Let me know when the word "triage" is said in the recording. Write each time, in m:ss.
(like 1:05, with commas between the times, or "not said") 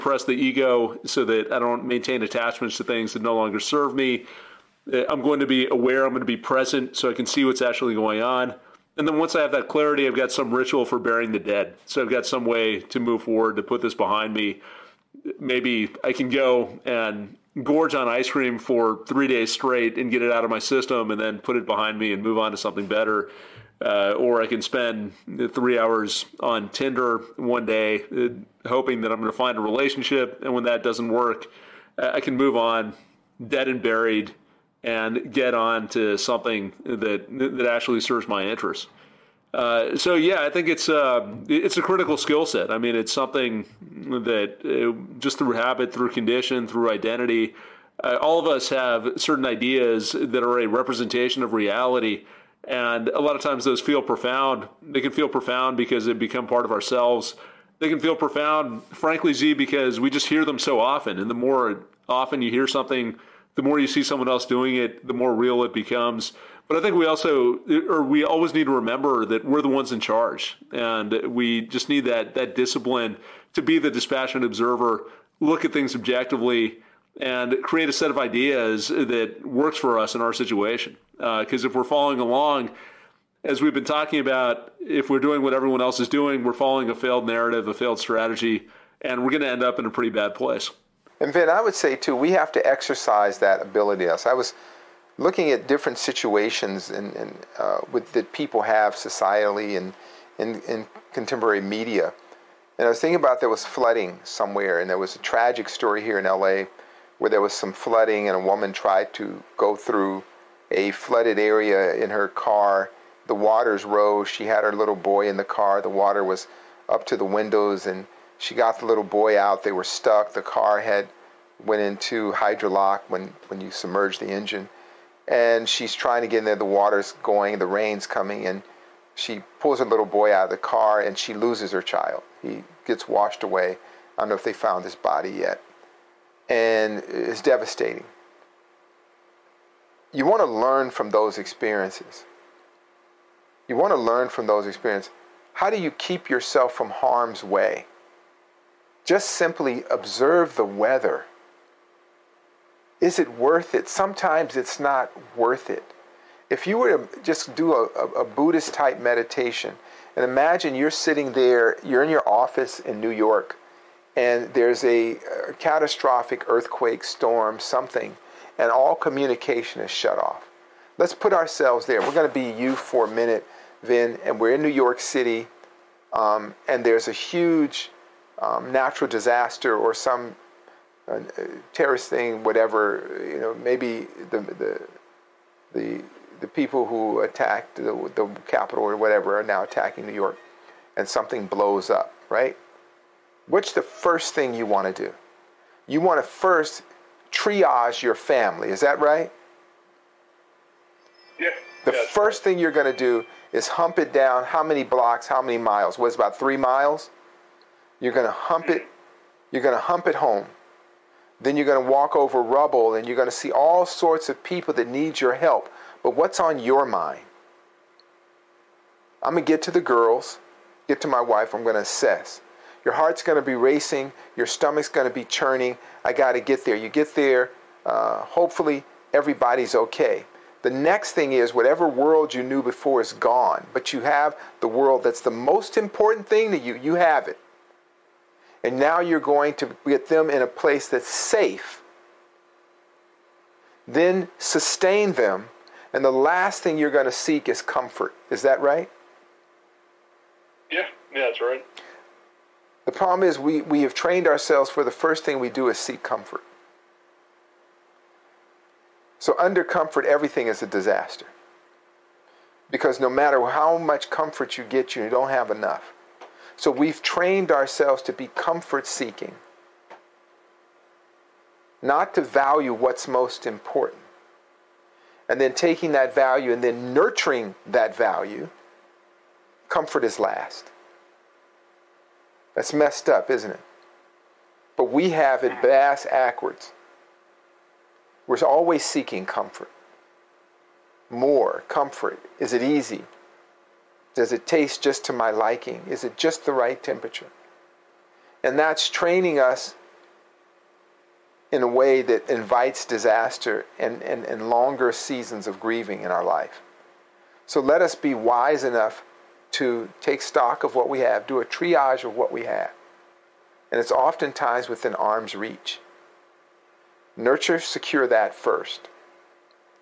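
3:17, 5:11.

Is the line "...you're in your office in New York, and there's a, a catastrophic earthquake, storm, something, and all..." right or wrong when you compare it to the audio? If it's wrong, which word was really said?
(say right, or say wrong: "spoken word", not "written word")
right.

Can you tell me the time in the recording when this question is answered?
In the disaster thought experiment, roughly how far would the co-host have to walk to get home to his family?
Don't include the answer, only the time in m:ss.
3:26.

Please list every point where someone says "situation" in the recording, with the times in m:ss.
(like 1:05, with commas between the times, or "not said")
1:20, 1:35.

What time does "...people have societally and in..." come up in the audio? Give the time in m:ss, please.
1:38.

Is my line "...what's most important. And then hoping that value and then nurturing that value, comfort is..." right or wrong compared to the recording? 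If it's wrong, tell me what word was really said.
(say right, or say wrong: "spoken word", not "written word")
wrong: "taking", not "hoping".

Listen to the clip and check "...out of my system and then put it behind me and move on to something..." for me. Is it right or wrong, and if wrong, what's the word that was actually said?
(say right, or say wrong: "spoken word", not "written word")
right.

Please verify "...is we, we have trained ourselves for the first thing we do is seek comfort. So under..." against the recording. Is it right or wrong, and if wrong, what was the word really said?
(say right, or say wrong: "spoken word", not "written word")
right.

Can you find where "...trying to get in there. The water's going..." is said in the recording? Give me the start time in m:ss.
2:05.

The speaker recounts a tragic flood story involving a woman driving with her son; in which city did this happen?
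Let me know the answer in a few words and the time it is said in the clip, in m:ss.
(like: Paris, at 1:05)
LA, at 1:46.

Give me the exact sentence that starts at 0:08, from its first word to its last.
And then once I have that clarity, I've got some ritual for burying the dead.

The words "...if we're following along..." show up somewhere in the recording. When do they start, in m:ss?
1:21.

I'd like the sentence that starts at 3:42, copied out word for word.
Your heart's going to be racing, your stomach's going to be churning.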